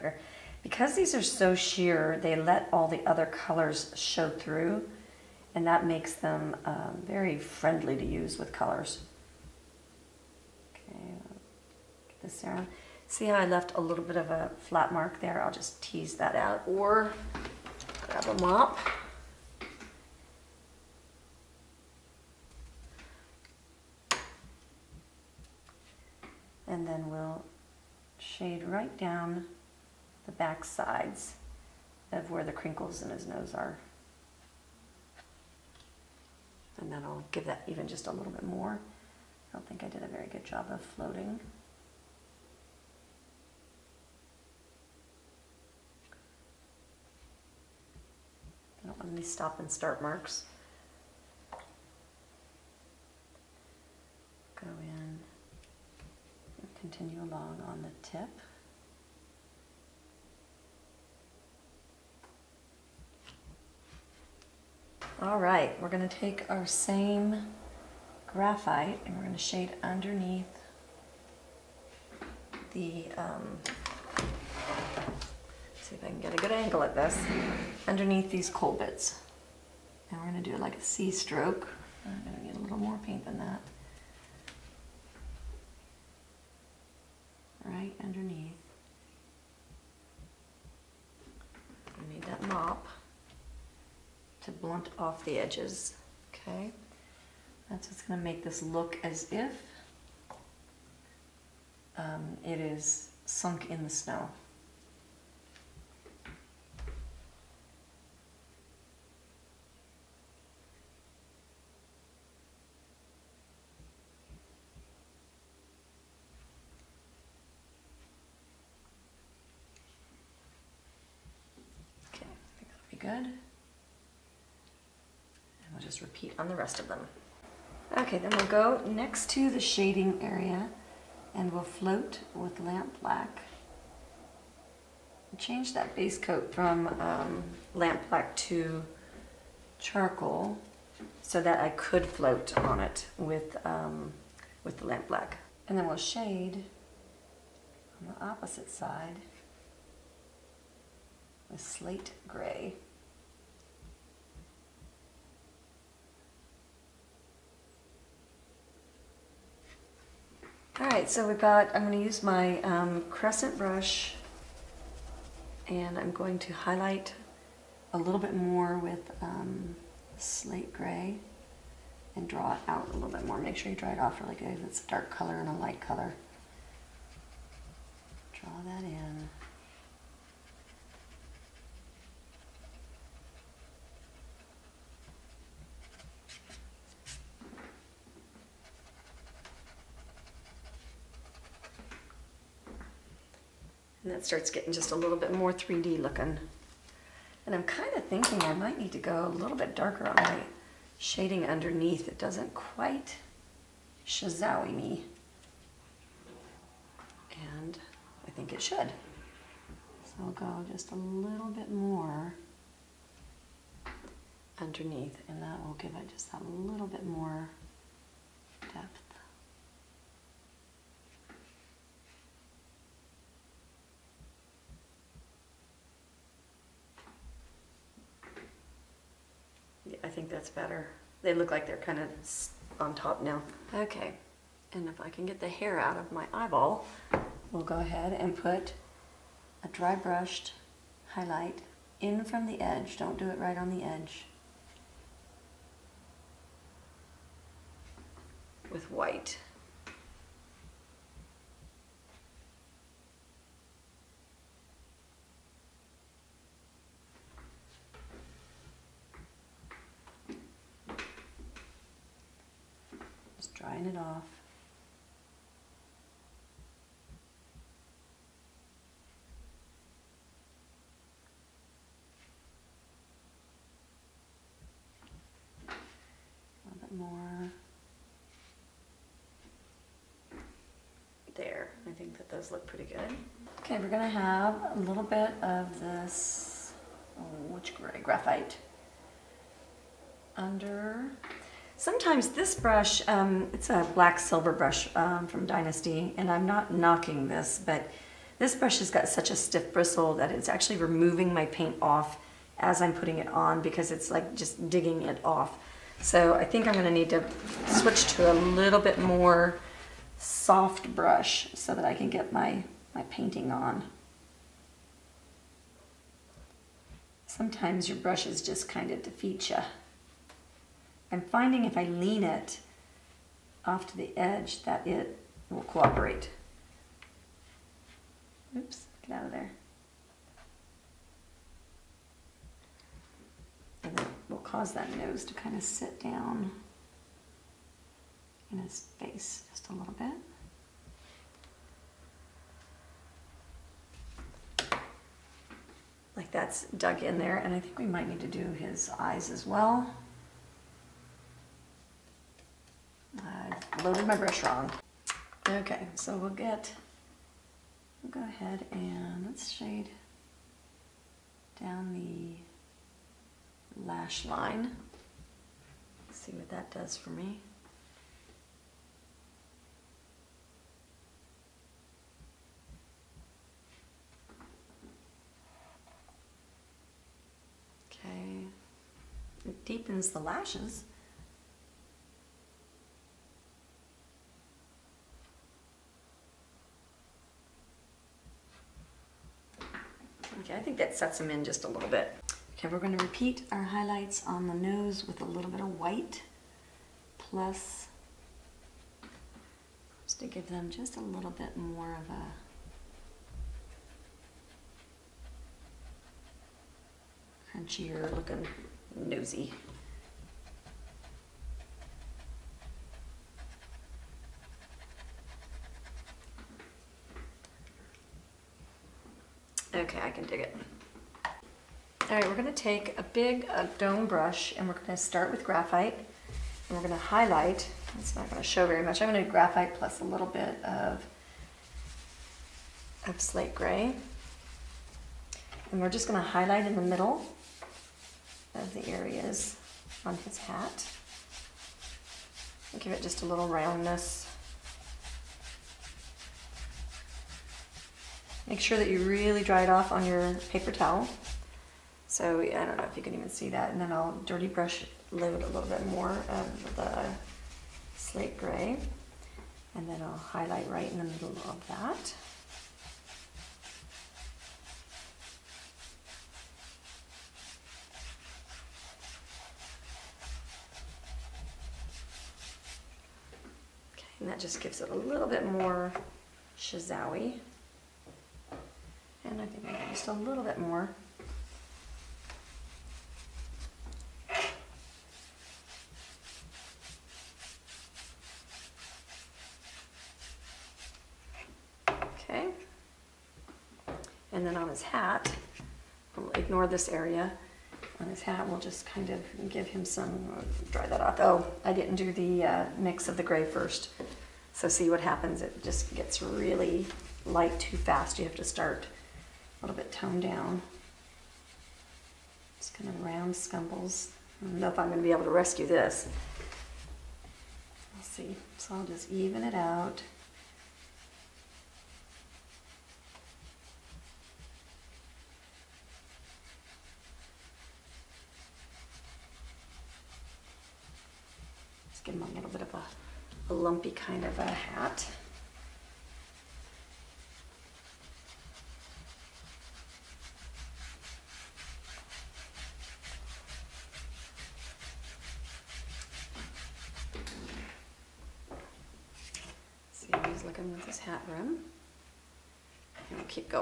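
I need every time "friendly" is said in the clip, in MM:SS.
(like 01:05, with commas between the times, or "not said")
00:07.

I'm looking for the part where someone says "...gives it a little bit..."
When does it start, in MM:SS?
07:54.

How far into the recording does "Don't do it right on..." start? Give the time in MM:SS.
04:02.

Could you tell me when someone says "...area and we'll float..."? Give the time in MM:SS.
02:10.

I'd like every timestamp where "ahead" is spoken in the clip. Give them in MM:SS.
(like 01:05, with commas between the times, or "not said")
03:57, 05:58.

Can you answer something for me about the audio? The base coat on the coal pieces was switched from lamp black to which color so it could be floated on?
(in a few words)
Charcoal.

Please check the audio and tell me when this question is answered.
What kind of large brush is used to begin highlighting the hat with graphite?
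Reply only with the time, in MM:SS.
07:03.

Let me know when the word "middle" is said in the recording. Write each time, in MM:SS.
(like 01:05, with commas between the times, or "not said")
07:16, 07:41.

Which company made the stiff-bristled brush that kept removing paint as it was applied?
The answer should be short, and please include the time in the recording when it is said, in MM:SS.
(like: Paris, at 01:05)
Dynasty, at 04:55.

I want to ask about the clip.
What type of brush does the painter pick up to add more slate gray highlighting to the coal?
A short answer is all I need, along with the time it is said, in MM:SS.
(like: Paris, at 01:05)
Crescent brush, at 02:43.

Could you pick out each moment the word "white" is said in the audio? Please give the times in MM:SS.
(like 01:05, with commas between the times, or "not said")
04:08, 06:35.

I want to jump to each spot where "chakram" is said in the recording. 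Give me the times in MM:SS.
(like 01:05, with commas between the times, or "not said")
09:11.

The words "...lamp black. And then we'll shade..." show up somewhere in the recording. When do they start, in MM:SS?
02:24.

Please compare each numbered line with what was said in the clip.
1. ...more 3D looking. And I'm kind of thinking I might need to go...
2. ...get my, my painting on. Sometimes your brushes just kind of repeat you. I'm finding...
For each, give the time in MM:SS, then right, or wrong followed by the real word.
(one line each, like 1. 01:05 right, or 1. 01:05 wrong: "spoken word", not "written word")
1. 03:15 right
2. 05:12 wrong: "defeat", not "repeat".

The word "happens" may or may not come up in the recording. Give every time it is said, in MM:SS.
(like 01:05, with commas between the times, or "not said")
08:25.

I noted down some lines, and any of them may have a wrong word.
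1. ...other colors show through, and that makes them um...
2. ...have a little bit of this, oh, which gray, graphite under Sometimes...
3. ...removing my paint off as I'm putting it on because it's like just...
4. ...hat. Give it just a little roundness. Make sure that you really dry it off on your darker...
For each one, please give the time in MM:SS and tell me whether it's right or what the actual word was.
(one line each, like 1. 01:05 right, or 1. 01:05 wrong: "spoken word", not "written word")
1. 00:03 right
2. 04:44 right
3. 05:00 right
4. 07:20 wrong: "paper", not "darker".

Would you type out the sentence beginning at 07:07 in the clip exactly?
It's not gonna show very much.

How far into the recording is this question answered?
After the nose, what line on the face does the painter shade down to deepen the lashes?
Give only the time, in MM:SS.
06:03.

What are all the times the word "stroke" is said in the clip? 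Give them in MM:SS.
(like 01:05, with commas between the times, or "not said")
01:21.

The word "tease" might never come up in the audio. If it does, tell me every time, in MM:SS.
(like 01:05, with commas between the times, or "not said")
00:15.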